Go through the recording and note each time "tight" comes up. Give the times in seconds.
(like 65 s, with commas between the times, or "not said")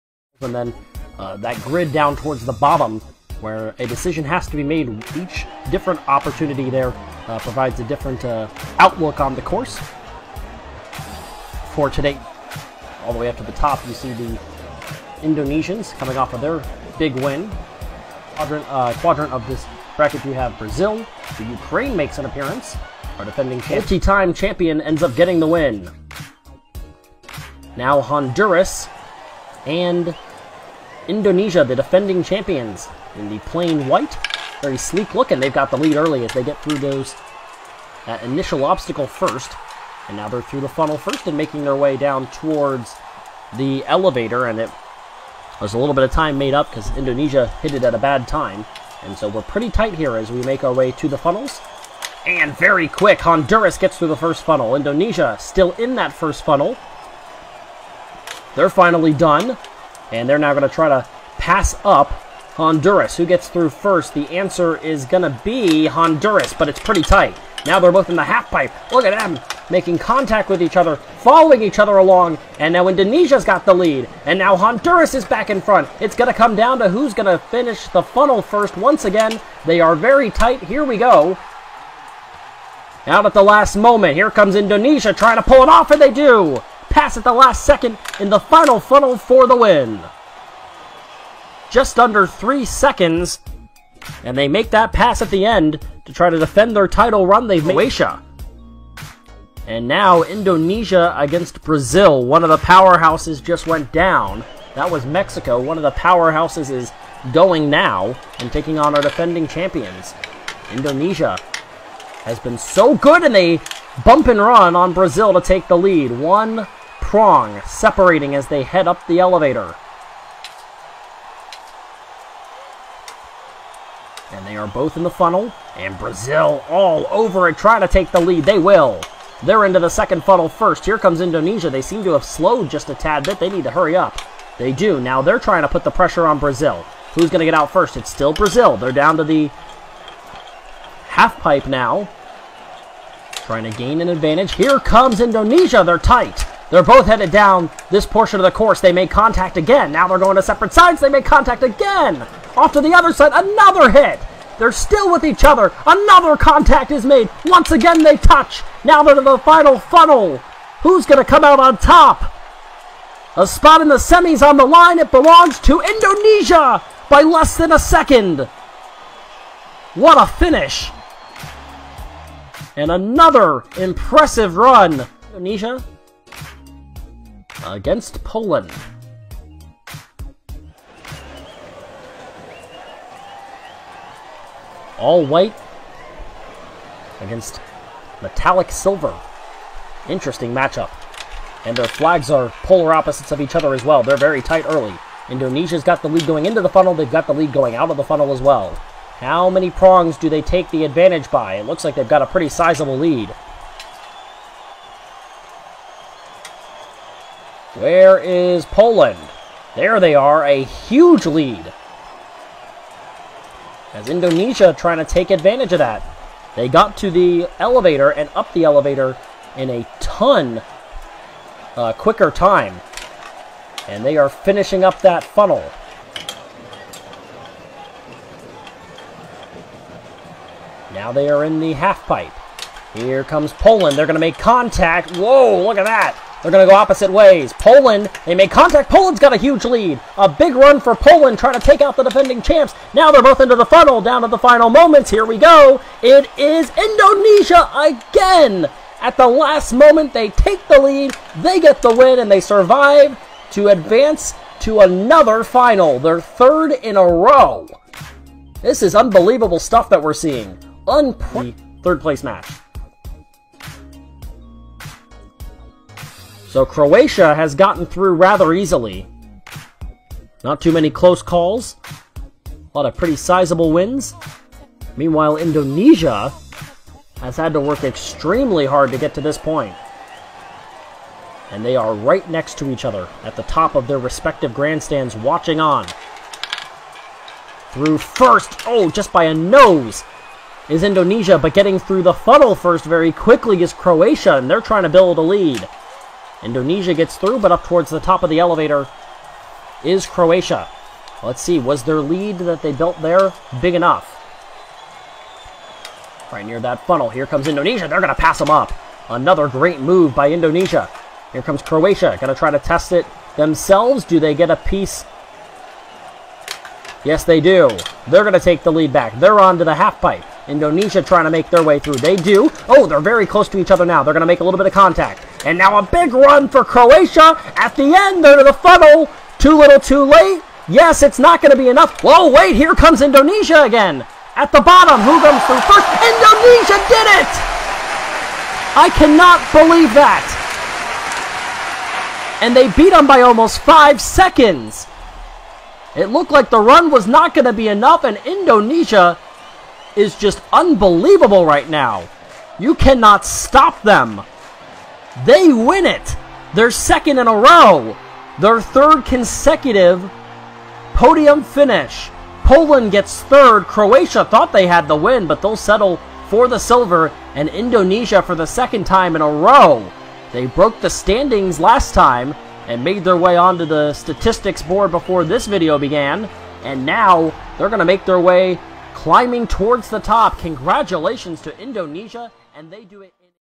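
49 s, 67 s, 80 s, 145 s, 194 s.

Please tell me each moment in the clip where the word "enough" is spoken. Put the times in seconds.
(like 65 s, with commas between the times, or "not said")
303 s, 331 s, 347 s.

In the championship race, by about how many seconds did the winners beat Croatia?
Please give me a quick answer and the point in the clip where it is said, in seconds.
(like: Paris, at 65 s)
Almost 5 seconds, at 343 s.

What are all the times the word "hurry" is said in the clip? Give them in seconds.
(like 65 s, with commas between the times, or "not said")
133 s.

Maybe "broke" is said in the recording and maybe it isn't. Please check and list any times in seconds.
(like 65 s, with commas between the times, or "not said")
370 s.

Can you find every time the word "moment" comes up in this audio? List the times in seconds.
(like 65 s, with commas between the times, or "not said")
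83 s, 244 s, 249 s.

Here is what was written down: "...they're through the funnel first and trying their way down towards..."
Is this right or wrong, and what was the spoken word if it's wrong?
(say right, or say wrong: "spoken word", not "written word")
wrong: "making", not "trying".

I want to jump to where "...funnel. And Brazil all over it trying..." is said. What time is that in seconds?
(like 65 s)
125 s.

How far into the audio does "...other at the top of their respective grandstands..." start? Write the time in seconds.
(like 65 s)
282 s.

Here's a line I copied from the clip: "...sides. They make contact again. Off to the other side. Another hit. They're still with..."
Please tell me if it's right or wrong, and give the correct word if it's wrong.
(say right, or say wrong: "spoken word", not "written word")
right.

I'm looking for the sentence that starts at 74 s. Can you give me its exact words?
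And now Honduras is back in front.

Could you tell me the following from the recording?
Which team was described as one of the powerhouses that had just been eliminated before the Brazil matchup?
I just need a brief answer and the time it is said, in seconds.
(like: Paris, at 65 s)
Mexico, at 105 s.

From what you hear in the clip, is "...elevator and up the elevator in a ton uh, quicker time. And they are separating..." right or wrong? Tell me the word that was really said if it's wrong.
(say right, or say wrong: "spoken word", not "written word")
wrong: "finishing", not "separating".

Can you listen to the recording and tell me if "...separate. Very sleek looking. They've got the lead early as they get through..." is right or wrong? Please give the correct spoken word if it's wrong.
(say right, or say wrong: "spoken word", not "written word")
wrong: "white", not "separate".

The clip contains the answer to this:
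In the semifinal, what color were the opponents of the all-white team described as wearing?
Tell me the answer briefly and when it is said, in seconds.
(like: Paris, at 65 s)
Metallic silver, at 188 s.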